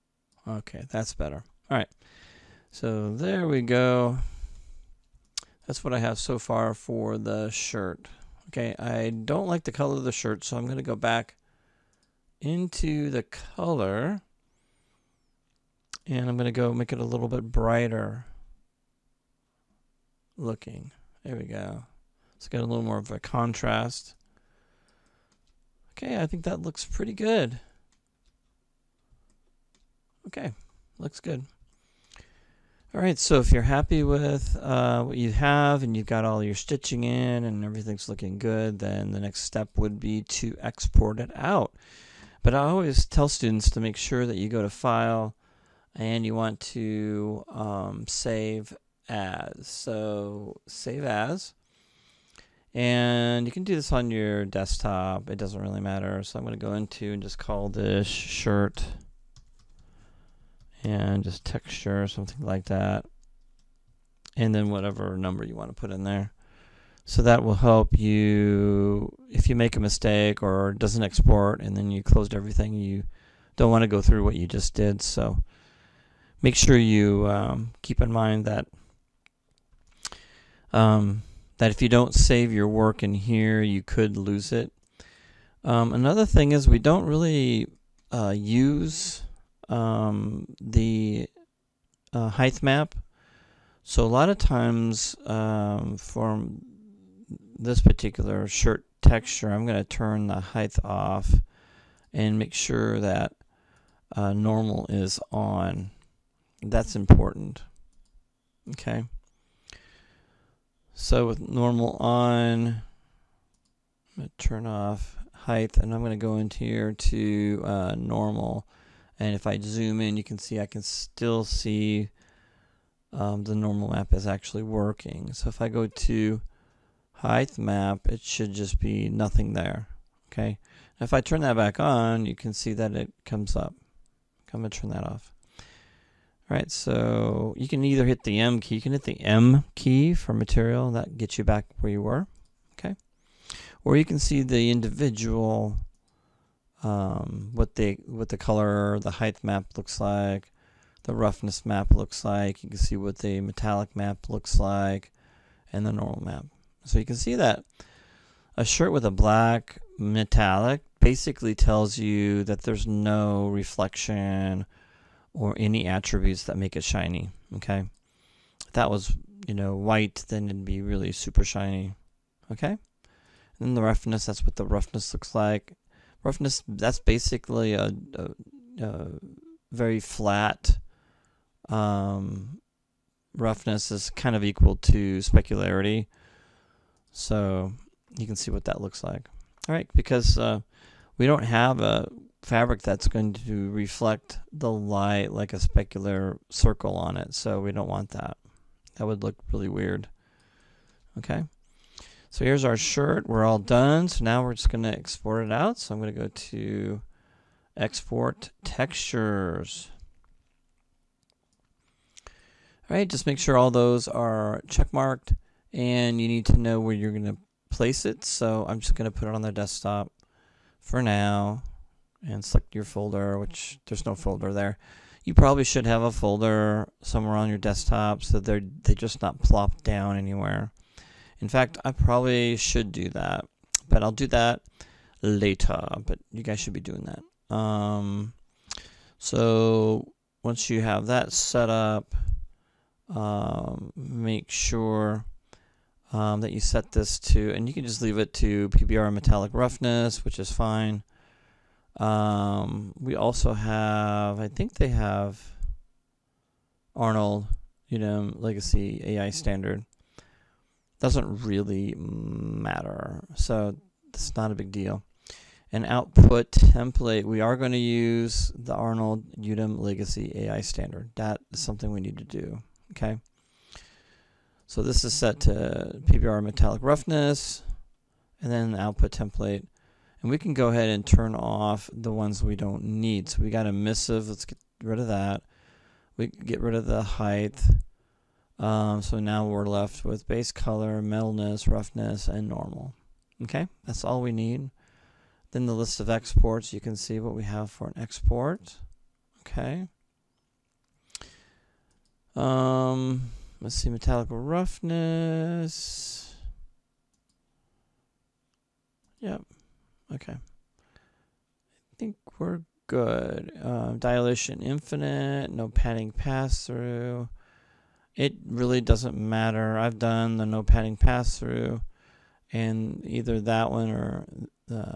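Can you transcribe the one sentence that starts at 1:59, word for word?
And if I zoom in, you can see I can still see um, the normal map is actually working.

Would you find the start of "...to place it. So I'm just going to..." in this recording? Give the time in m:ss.
3:37.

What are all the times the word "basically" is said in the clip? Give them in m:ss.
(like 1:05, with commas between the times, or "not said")
2:41, 2:57.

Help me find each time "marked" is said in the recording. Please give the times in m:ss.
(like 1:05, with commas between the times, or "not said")
3:34.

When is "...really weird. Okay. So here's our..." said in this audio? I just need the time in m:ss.
3:19.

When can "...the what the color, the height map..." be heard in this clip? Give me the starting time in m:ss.
2:27.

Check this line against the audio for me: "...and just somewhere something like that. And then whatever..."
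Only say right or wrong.
wrong.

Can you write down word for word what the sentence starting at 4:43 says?
So we got emissive, let's get rid of that.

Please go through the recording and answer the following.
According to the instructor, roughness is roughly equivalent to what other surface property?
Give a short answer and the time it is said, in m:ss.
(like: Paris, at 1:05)
specularity, at 3:05.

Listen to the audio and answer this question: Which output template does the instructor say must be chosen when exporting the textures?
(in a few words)
Arnold Udim Legacy AI standard.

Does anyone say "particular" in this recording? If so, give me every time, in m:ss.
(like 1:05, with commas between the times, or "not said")
1:37.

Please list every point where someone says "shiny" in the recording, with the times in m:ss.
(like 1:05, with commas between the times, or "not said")
2:46, 2:51.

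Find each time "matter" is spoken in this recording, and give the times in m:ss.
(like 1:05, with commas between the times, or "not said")
0:55, 4:21, 5:19.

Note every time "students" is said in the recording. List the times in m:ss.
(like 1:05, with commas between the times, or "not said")
0:43.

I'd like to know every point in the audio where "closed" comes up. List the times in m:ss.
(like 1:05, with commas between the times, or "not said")
1:12.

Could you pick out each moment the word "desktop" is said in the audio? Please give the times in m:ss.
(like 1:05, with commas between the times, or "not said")
0:54, 3:39, 3:47.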